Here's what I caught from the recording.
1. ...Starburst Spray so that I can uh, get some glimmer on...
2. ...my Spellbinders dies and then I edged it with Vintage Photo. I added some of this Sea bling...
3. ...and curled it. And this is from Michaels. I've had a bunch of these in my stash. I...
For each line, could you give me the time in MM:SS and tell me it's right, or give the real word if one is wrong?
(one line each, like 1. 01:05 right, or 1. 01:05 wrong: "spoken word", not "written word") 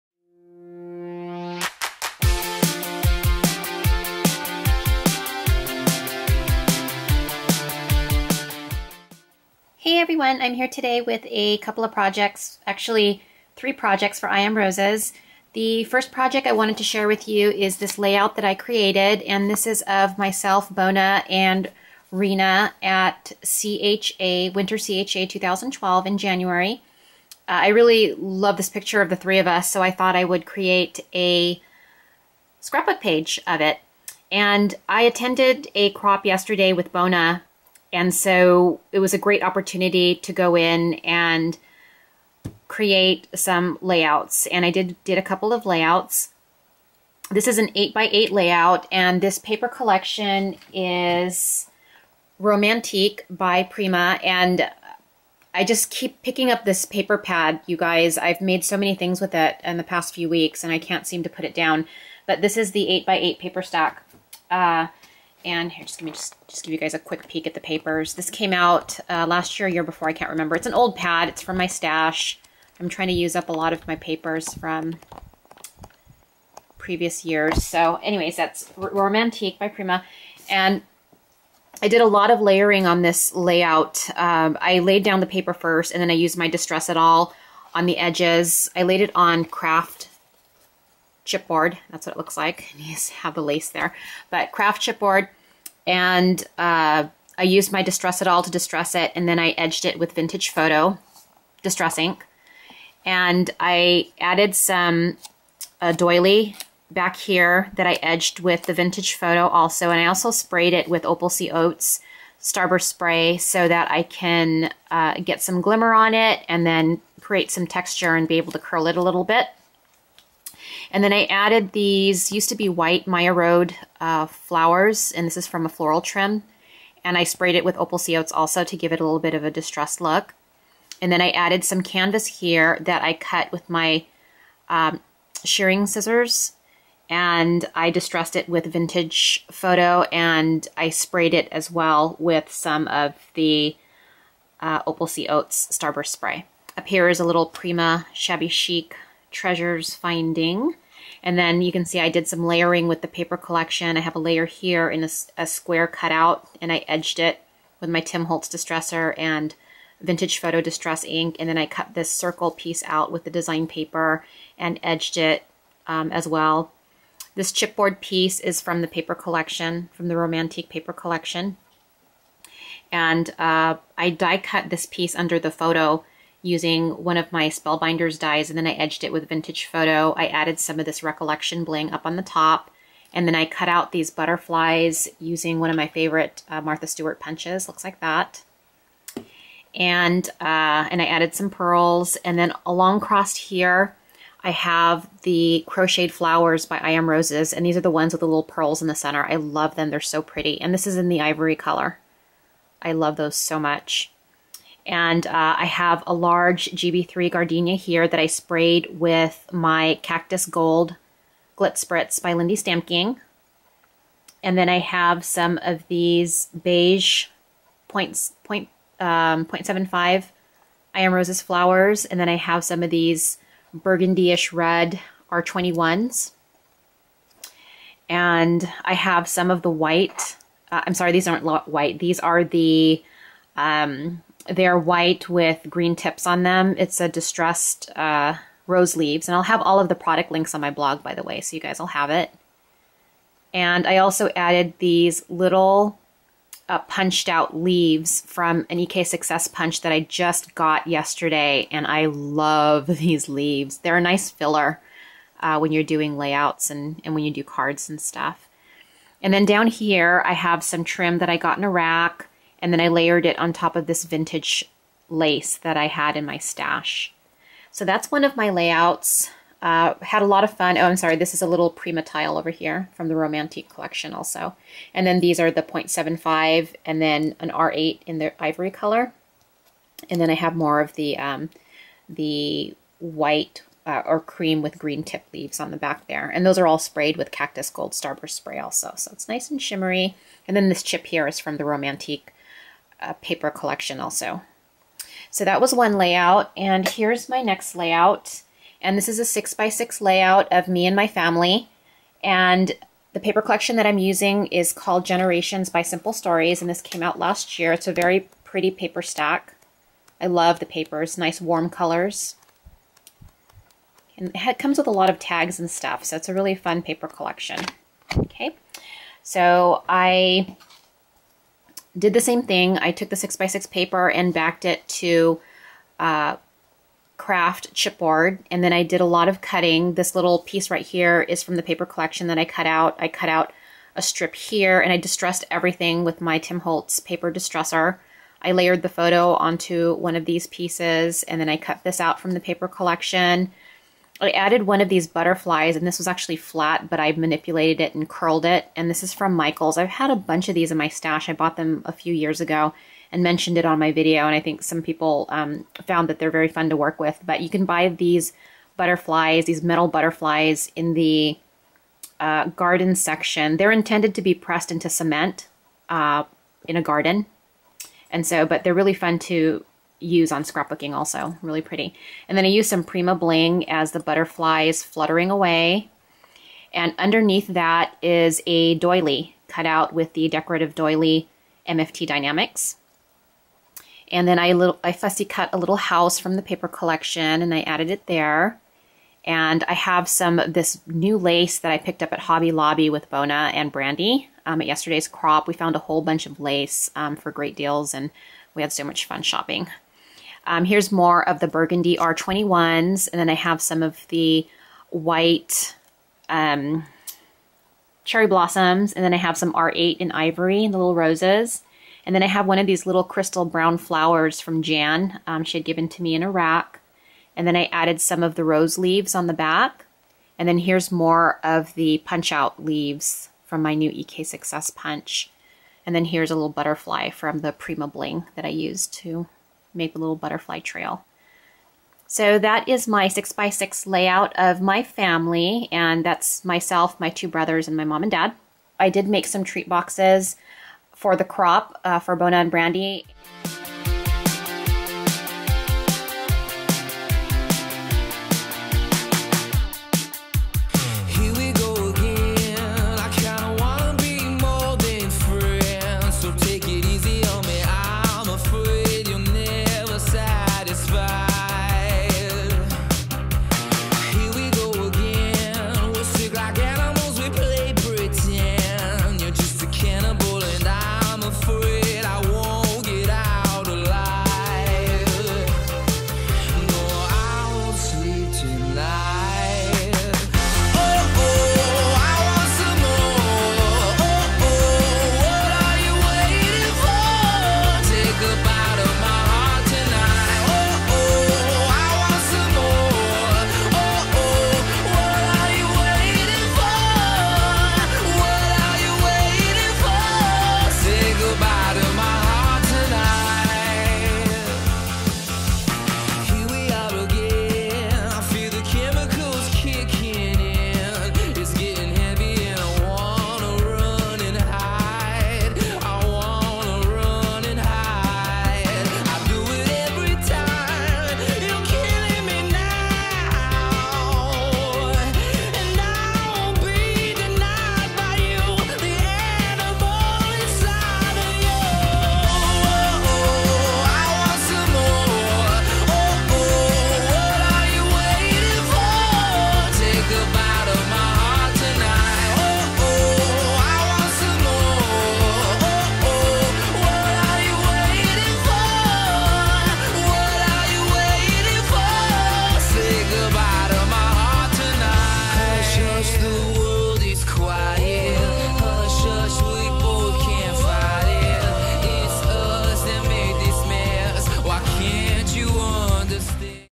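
1. 01:52 right
2. 02:57 wrong: "Recollection", not "Sea"
3. 05:47 right.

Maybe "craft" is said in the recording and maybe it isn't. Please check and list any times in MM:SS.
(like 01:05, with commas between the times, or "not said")
01:29, 01:34, 05:27.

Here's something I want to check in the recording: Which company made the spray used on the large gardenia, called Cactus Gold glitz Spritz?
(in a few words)
Lindy Stamping.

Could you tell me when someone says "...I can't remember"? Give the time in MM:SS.
01:10.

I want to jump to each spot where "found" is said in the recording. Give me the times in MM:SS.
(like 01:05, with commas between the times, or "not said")
05:55, 06:35.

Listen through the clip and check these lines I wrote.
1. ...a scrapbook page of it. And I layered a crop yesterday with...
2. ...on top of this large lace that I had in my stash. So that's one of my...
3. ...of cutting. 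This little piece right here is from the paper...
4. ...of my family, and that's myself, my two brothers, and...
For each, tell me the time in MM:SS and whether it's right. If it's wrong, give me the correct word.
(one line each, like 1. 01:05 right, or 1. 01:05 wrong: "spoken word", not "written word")
1. 00:31 wrong: "attended", not "layered"
2. 04:23 wrong: "vintage", not "large"
3. 05:29 right
4. 07:14 right.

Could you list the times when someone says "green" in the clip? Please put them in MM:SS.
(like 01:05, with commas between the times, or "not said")
03:55, 04:44.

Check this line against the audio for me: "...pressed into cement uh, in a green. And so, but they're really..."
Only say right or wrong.
wrong.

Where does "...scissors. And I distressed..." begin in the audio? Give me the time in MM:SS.
02:15.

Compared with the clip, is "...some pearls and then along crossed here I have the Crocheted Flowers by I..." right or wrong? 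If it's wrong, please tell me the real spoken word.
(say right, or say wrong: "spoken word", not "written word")
right.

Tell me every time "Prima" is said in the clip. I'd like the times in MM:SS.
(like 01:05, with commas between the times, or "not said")
00:53, 01:19, 02:27, 04:31, 06:12, 07:07.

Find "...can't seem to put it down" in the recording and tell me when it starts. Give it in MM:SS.
01:00.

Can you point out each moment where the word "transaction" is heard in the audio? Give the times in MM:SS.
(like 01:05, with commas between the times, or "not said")
not said.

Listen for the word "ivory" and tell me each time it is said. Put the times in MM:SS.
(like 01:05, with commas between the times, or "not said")
03:21, 04:38, 06:50.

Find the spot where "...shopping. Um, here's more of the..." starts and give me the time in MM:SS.
06:39.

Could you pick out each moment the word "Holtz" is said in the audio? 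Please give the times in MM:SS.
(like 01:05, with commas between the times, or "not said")
02:38, 05:36.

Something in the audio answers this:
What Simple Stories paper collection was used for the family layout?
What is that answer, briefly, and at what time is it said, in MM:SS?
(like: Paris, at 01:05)
Generations, at 05:05.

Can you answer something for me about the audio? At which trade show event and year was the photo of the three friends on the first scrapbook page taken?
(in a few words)
Winter CHA 2012.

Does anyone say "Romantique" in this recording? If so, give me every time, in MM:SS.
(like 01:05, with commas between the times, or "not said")
00:52, 01:18, 02:50, 04:33, 04:51.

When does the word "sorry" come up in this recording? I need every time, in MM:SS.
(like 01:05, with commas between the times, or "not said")
03:50, 04:30.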